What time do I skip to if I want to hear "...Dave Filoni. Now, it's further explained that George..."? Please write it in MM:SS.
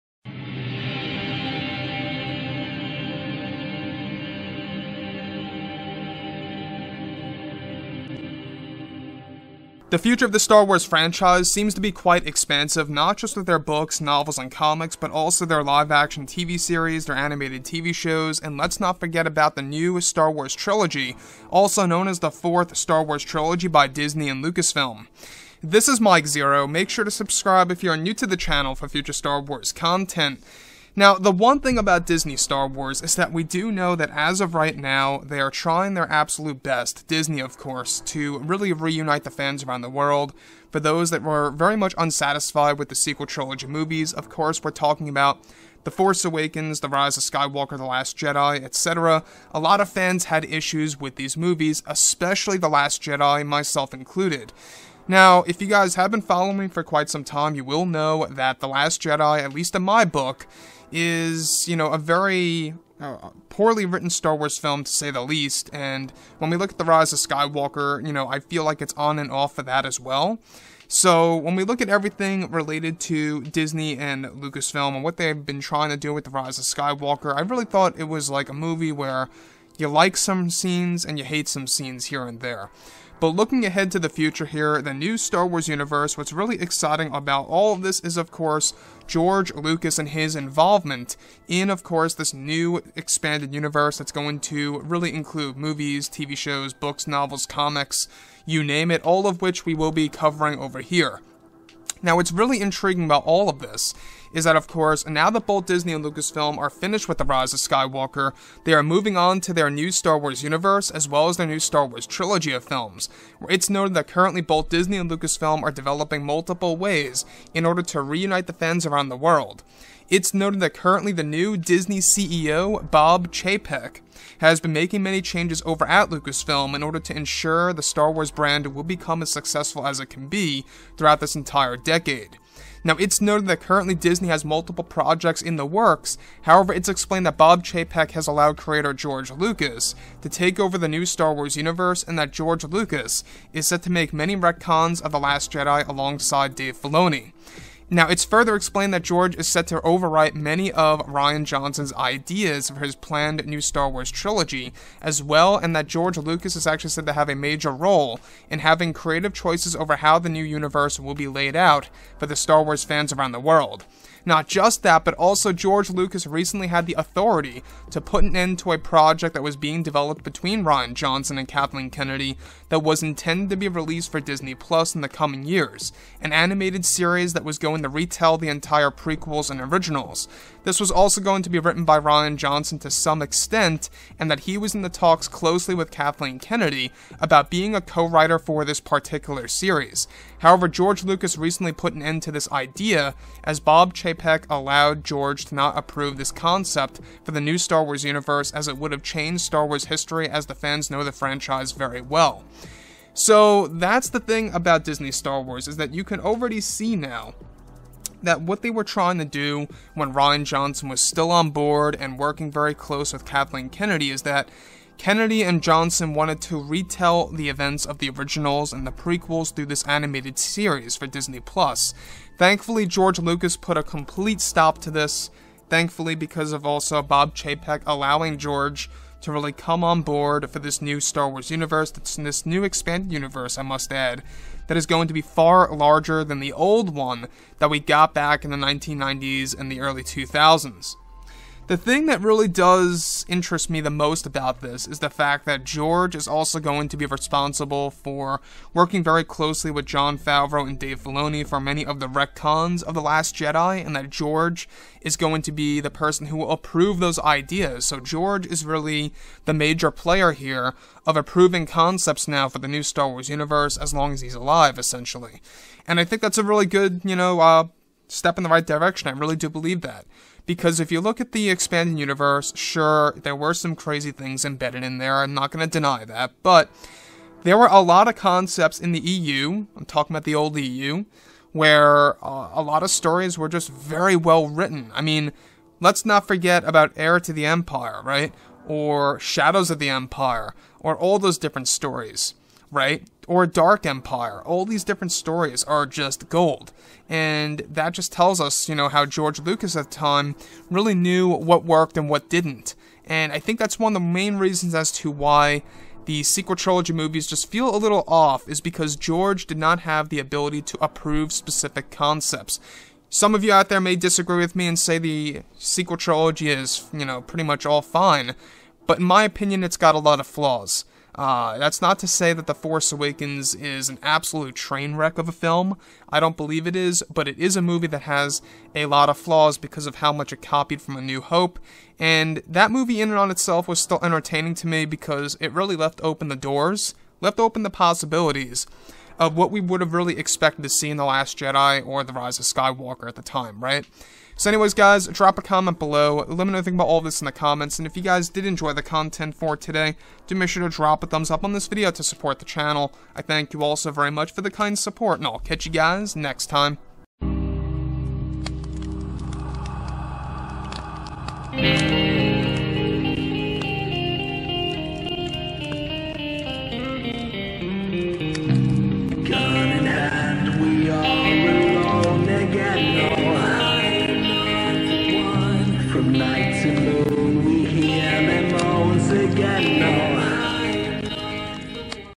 02:26.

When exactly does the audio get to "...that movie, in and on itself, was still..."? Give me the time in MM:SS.
05:32.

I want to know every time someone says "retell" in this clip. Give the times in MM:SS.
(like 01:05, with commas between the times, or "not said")
02:57, 03:36.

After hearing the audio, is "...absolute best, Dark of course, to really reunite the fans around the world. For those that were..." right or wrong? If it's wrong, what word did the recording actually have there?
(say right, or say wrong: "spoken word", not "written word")
wrong: "Disney", not "Dark".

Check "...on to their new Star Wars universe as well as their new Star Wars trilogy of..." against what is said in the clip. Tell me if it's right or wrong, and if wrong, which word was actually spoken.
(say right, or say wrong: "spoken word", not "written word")
right.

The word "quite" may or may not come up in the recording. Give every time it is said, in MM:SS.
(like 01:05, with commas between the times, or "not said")
00:11, 00:56.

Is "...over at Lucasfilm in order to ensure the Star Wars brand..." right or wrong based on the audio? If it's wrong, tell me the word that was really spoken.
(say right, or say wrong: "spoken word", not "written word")
right.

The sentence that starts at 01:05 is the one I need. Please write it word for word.
And when we look at The Rise of Skywalker, you know, I feel like it's on and off for that as well.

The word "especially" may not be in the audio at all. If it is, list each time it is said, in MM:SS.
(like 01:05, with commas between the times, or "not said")
00:51.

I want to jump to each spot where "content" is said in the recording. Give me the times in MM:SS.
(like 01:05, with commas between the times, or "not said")
00:29, 05:48.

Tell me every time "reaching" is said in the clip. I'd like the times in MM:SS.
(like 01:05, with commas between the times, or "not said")
not said.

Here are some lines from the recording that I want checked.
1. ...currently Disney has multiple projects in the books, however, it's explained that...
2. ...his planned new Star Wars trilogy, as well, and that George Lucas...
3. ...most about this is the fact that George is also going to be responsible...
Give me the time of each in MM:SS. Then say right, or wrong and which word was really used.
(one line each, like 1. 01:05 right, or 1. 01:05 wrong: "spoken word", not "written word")
1. 02:13 wrong: "works", not "books"
2. 02:32 right
3. 04:03 right.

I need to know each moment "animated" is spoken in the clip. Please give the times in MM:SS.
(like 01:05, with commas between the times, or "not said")
00:17, 02:56, 03:39.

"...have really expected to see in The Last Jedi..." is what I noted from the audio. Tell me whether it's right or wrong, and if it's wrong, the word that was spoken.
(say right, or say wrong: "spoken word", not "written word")
right.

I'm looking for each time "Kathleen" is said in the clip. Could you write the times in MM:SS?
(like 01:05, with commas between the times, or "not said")
02:51, 03:05, 03:33.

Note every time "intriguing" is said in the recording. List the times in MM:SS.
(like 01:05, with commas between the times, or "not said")
01:42.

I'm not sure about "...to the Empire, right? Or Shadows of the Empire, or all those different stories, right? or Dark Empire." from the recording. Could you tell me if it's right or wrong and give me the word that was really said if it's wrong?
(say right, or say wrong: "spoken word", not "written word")
right.